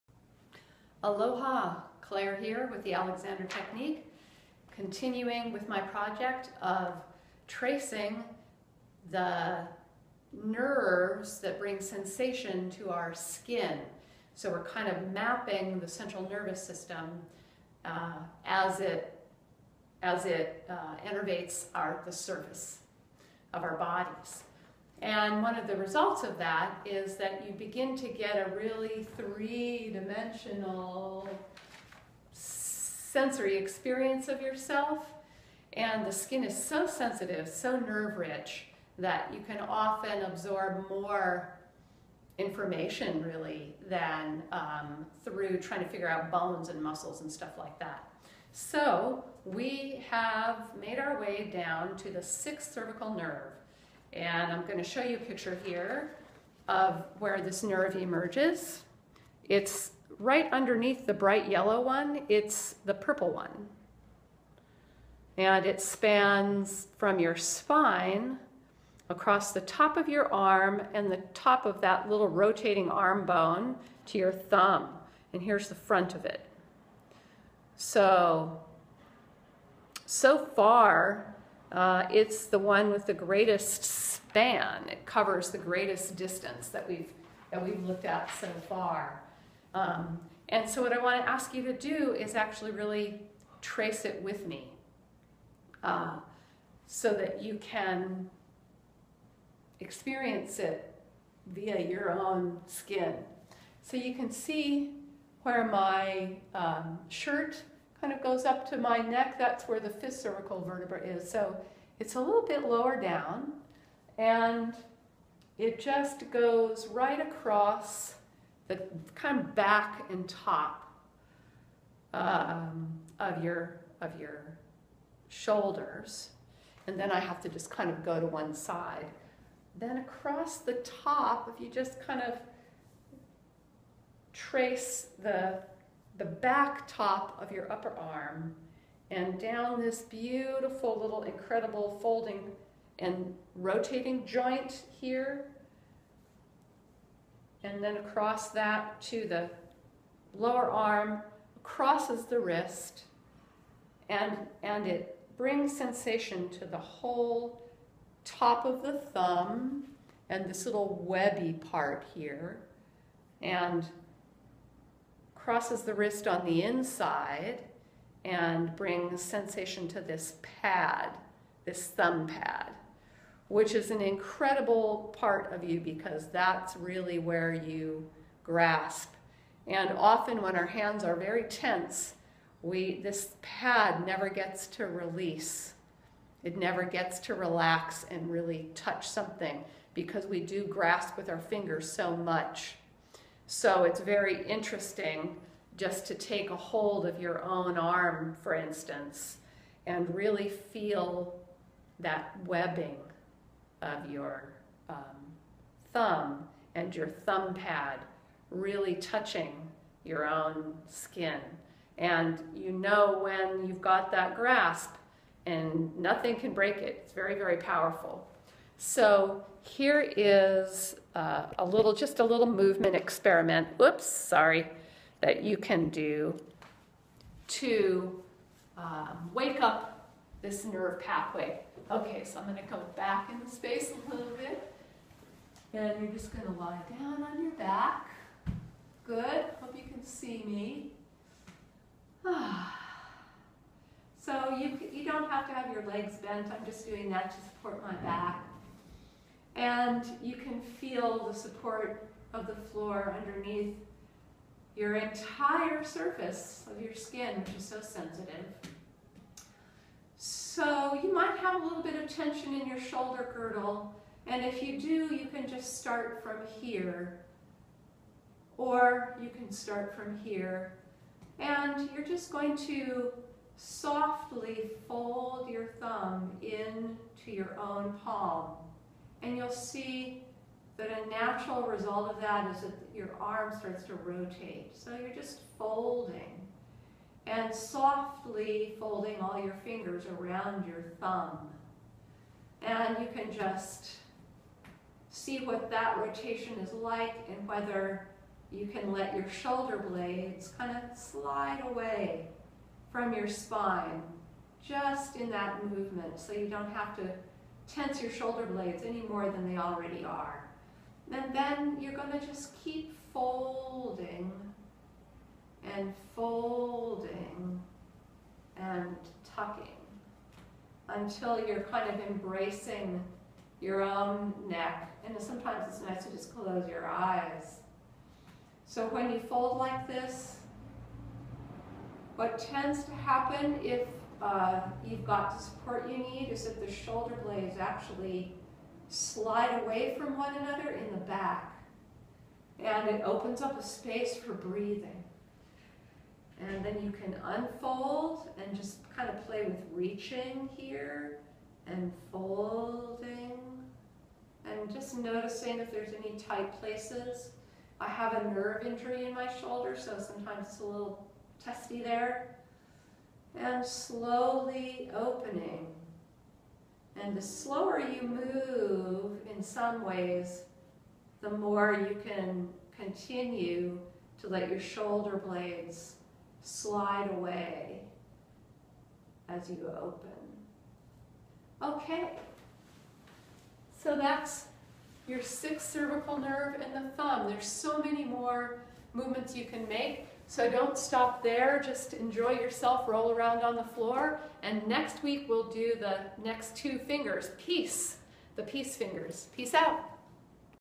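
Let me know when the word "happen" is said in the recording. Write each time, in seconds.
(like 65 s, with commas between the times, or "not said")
332 s.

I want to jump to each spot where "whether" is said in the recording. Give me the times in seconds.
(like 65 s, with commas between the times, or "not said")
297 s.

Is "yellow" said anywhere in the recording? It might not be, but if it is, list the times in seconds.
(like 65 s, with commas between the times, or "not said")
61 s.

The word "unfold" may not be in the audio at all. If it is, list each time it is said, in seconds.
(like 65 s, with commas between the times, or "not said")
347 s.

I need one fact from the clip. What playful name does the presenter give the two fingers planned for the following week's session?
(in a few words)
The peace fingers.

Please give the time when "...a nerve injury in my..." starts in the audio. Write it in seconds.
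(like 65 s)
358 s.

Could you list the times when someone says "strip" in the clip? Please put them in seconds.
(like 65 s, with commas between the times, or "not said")
not said.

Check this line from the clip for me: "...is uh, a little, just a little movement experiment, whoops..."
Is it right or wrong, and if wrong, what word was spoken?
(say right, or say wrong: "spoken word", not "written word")
right.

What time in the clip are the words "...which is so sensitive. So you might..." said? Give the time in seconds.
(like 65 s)
257 s.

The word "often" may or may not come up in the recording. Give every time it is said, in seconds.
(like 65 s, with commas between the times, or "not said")
39 s, 179 s.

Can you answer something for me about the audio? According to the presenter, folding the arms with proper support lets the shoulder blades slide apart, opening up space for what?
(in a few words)
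Breathing.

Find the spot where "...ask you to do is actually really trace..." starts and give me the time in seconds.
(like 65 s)
91 s.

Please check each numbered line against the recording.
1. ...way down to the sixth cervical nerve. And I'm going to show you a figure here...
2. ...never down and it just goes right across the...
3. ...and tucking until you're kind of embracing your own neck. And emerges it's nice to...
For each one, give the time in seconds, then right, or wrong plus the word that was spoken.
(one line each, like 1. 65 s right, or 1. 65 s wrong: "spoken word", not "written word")
1. 51 s wrong: "picture", not "figure"
2. 112 s wrong: "lower", not "never"
3. 318 s wrong: "sometimes", not "emerges".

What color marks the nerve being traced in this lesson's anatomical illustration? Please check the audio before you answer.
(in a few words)
Purple.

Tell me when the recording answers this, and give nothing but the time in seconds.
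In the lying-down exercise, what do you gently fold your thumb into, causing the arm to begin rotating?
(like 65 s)
277 s.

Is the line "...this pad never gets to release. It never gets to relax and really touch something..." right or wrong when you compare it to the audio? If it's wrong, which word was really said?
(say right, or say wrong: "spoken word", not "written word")
right.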